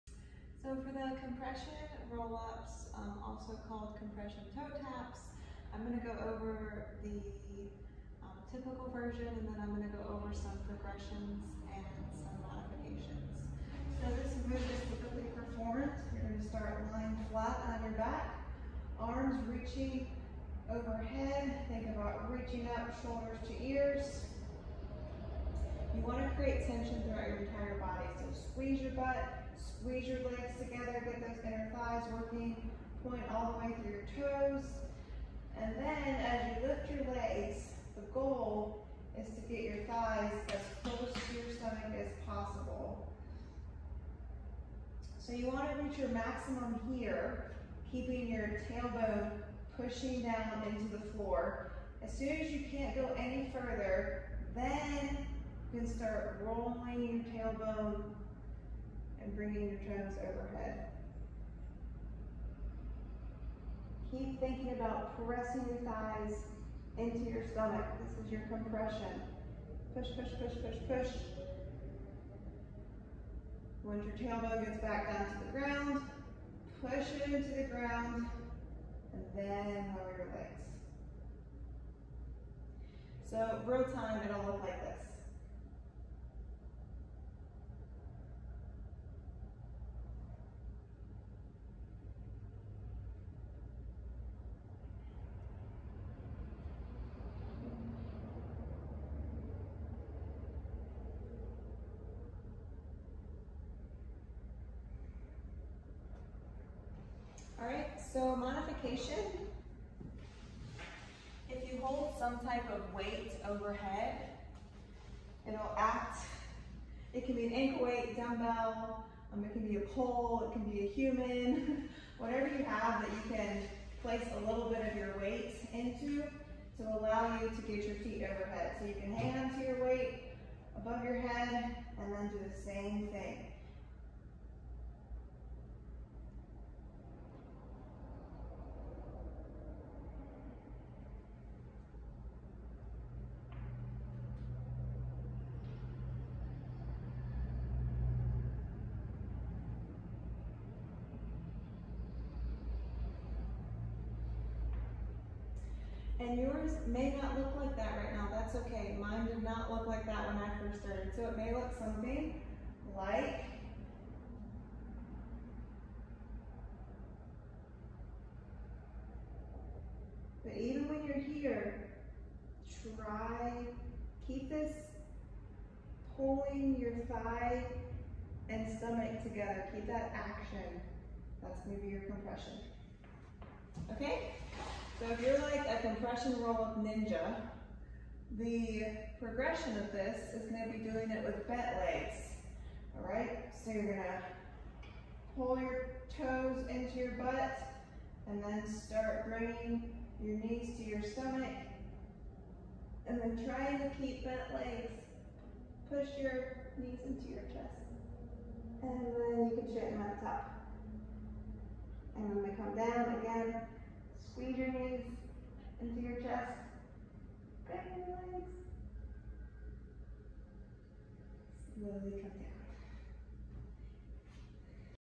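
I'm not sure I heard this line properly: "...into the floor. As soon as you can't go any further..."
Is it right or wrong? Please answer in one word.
right.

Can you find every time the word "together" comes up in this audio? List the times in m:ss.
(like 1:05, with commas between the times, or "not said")
0:30, 2:59.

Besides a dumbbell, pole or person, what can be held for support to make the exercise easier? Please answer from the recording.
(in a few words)
ankle weight.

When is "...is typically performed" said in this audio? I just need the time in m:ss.
0:14.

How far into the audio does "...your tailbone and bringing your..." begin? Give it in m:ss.
0:57.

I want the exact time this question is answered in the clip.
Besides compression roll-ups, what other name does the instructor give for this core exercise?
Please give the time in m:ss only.
0:03.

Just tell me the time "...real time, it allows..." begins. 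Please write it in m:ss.
1:23.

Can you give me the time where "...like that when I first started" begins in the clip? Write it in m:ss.
2:39.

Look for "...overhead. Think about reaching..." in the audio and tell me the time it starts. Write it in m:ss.
0:20.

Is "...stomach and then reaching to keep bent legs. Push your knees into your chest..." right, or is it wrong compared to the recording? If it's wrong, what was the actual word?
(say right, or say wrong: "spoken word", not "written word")
wrong: "trying", not "reaching".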